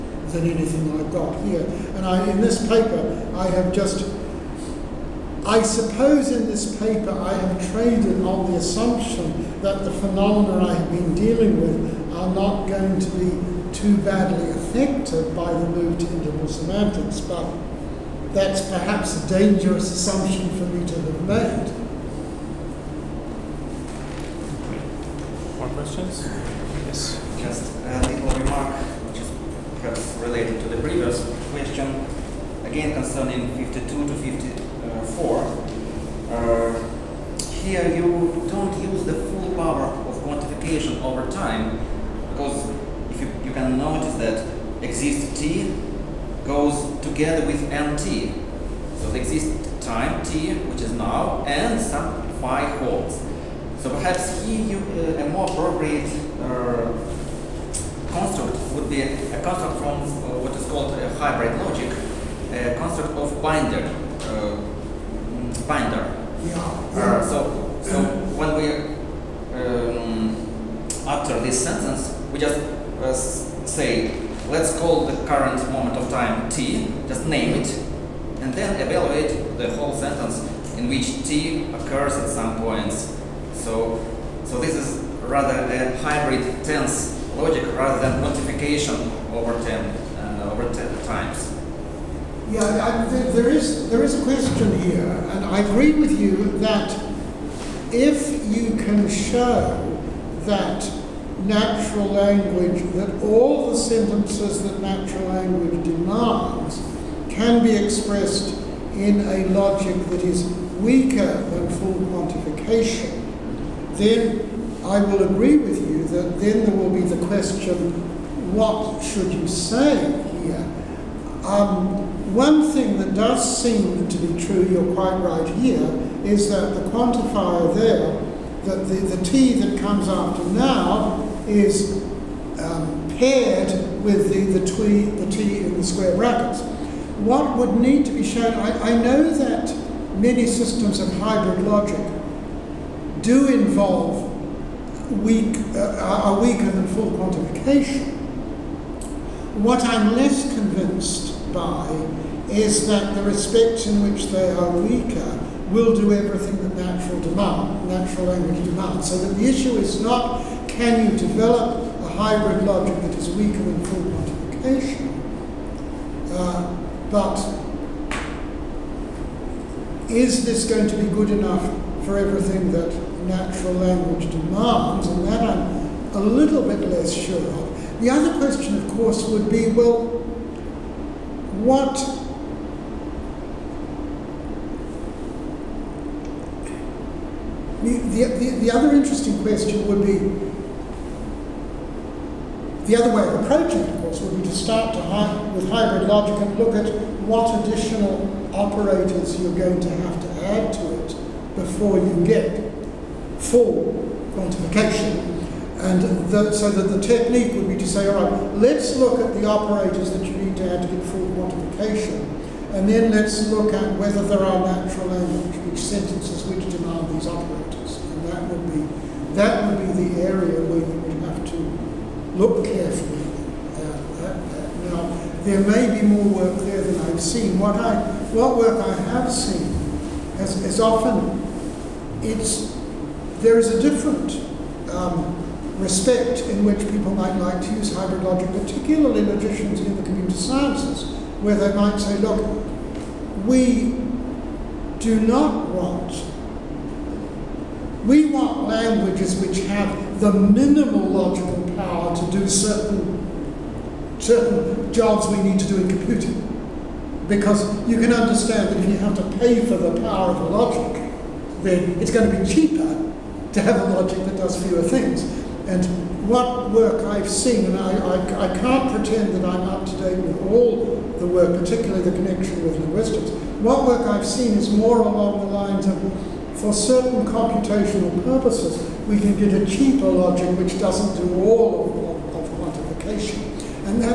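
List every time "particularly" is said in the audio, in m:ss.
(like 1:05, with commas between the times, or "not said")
3:58, 4:31.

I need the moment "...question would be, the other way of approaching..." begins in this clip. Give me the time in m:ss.
3:09.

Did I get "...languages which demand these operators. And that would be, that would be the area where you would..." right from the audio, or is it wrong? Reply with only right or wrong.
wrong.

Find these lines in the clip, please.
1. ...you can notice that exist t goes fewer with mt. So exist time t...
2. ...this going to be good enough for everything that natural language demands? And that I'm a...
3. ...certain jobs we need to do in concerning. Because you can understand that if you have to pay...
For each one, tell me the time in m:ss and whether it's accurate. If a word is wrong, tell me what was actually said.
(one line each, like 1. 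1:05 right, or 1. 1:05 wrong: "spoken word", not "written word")
1. 0:43 wrong: "together", not "fewer"
2. 2:50 right
3. 4:14 wrong: "computing", not "concerning".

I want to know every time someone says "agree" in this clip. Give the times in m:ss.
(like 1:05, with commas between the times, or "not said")
1:35, 1:55.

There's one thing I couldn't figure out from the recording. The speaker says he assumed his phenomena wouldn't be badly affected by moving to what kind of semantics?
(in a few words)
interval semantics.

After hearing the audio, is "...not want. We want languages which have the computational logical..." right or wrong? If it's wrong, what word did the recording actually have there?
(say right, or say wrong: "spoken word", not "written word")
wrong: "minimal", not "computational".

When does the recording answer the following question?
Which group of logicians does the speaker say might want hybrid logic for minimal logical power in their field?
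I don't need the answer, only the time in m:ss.
3:59.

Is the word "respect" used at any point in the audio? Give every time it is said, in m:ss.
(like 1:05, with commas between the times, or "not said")
2:33, 3:55.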